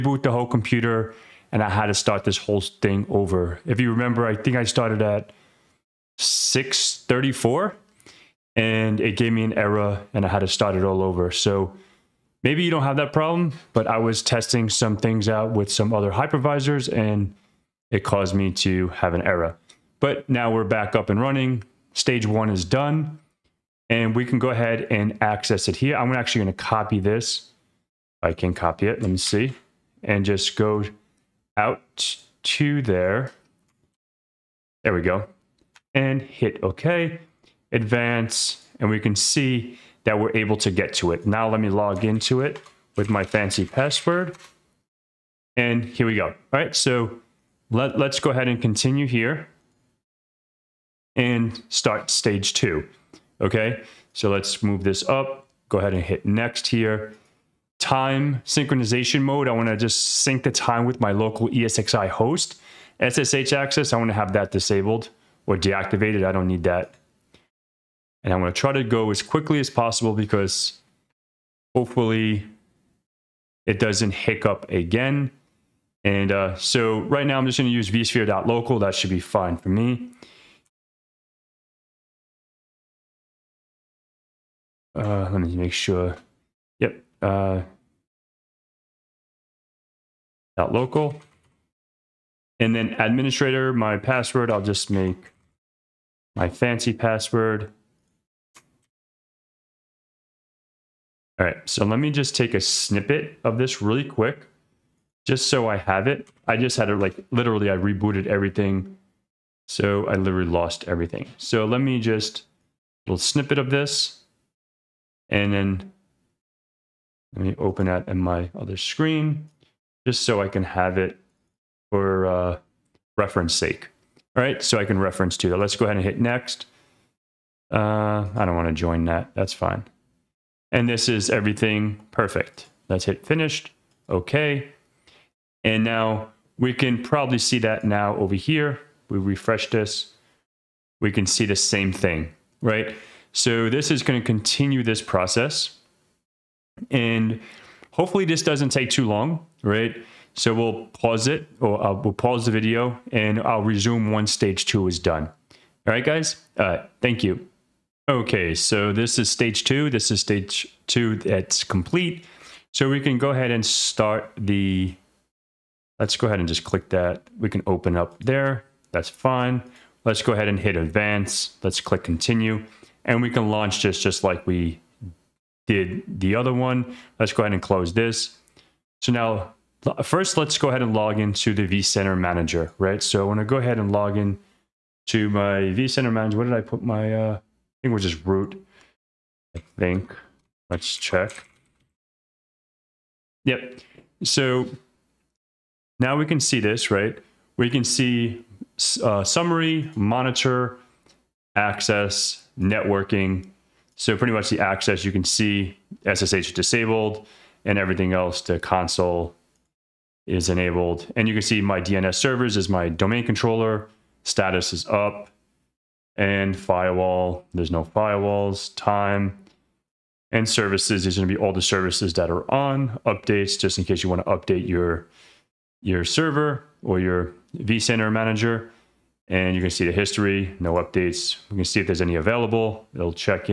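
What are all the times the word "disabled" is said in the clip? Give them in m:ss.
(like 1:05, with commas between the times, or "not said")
1:04, 3:26.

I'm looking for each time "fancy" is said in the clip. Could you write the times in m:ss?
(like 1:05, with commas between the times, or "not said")
0:43, 1:36.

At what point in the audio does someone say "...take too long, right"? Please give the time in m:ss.
2:28.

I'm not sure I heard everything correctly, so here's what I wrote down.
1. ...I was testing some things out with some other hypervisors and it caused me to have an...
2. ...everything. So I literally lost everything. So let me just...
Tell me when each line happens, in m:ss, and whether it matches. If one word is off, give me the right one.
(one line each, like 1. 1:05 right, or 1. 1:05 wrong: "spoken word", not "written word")
1. 0:13 right
2. 1:48 right.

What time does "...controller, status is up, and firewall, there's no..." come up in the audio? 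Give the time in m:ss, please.
3:33.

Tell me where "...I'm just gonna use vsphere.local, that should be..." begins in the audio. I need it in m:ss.
1:17.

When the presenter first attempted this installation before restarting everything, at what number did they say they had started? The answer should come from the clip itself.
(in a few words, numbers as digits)
634.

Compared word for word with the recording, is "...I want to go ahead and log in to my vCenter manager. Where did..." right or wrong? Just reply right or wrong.
right.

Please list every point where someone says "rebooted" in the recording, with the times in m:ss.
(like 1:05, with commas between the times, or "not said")
1:47.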